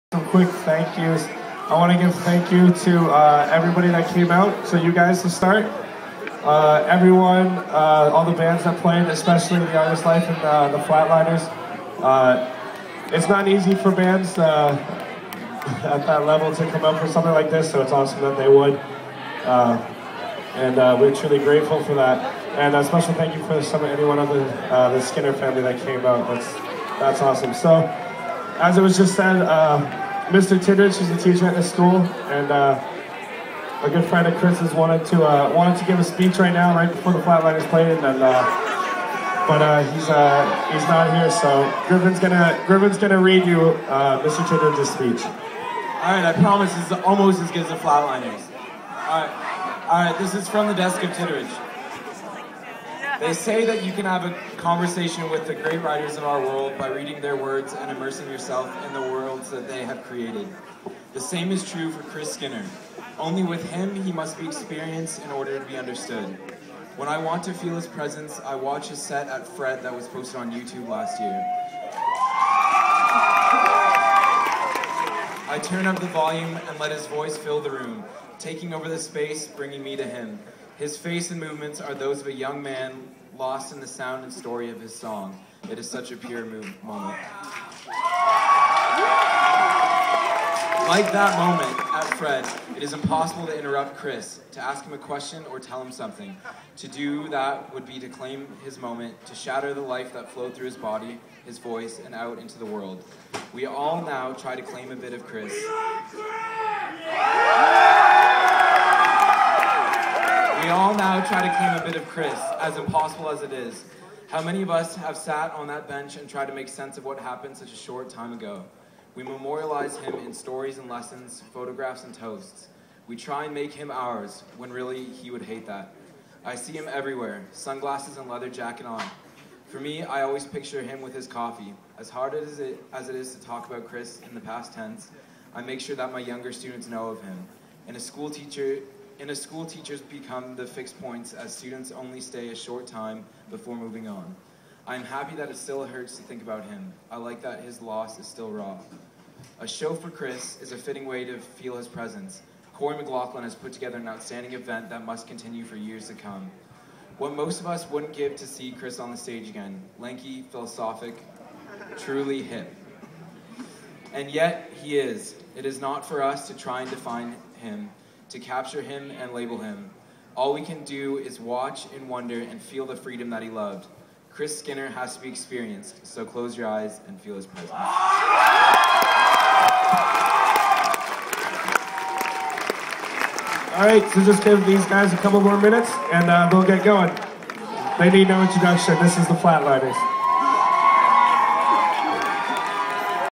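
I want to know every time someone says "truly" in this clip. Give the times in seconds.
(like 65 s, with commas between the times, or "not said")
21 s, 161 s.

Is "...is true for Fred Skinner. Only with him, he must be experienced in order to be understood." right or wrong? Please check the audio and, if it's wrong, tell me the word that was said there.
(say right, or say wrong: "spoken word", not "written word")
wrong: "Chris", not "Fred".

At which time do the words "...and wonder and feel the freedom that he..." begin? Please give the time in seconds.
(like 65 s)
171 s.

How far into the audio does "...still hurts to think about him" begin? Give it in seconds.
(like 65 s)
145 s.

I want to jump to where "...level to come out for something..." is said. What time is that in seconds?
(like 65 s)
16 s.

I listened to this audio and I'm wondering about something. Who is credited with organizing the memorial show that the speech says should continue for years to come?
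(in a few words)
Corey McLaughlin.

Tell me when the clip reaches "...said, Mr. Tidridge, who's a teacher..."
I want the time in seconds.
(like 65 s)
29 s.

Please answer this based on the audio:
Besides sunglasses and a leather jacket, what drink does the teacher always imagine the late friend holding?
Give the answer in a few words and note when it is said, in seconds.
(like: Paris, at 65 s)
Coffee, at 131 s.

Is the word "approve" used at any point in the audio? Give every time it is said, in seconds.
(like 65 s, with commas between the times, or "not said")
not said.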